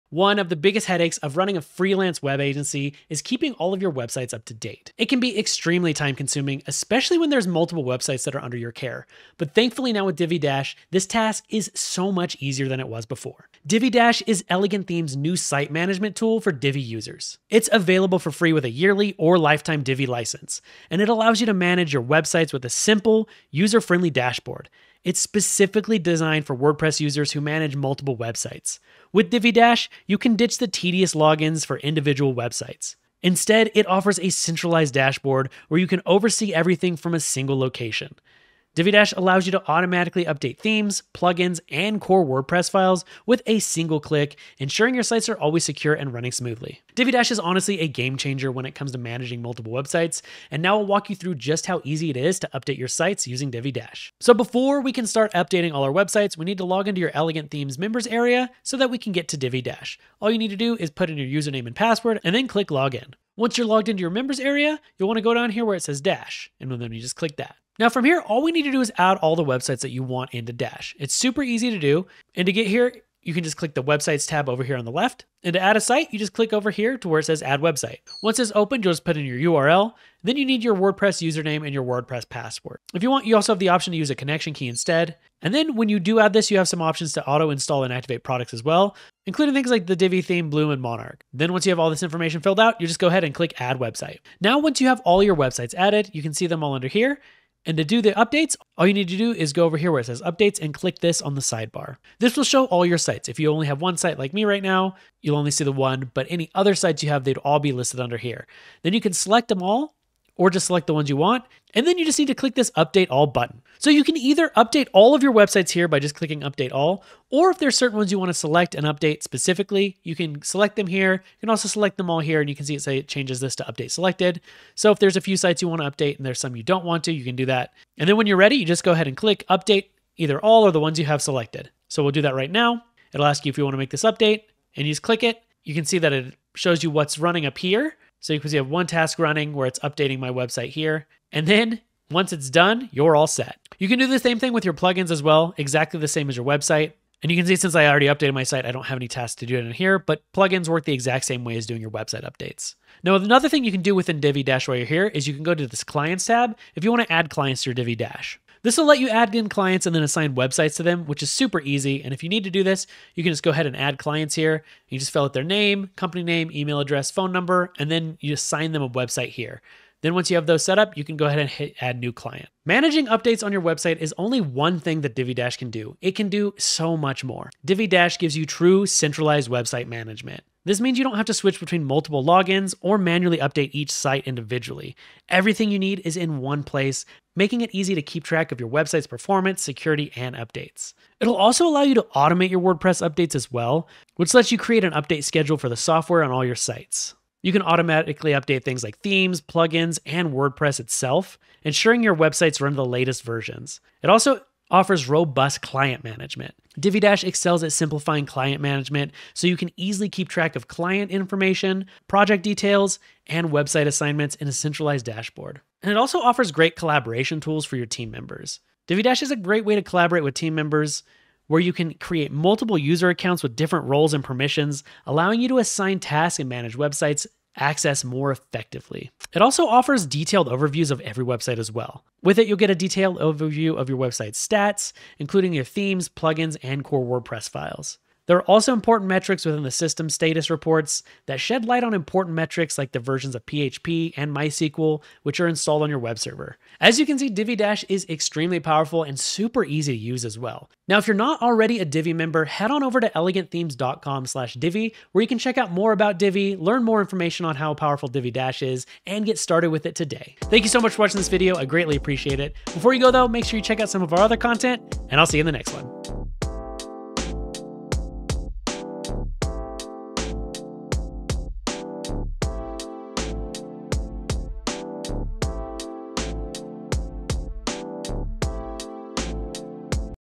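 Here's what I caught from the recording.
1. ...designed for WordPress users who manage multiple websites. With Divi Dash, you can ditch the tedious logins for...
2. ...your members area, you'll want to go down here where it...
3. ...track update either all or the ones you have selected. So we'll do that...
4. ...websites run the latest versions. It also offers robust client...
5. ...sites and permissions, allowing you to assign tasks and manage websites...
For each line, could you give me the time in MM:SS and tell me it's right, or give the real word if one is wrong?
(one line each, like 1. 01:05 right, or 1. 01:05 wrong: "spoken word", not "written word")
1. 00:25 right
2. 01:04 right
3. 02:09 wrong: "click", not "track"
4. 03:22 right
5. 03:43 wrong: "roles", not "sites".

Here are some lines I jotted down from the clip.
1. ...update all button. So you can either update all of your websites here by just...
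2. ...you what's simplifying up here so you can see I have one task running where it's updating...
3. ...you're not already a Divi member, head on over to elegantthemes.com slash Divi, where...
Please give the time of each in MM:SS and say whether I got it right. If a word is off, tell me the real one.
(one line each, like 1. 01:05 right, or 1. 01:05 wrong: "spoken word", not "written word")
1. 01:52 right
2. 02:16 wrong: "running", not "simplifying"
3. 04:11 right.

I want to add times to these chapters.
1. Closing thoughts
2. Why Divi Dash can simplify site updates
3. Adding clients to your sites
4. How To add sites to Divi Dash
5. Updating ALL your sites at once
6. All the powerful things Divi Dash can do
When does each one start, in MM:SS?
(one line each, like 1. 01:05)
1. 04:06
2. 00:13
3. 02:32
4. 00:53
5. 01:42
6. 02:52.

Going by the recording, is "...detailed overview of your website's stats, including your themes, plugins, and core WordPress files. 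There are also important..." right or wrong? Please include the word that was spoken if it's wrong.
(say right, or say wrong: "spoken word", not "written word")
right.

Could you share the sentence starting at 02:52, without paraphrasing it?
Managing updates on your website is only one thing that Divi Dash can do.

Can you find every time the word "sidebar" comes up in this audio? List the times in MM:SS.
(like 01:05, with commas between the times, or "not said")
01:41.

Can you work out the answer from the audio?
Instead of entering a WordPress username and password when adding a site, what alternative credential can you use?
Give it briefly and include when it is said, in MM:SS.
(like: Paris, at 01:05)
Connection key, at 01:24.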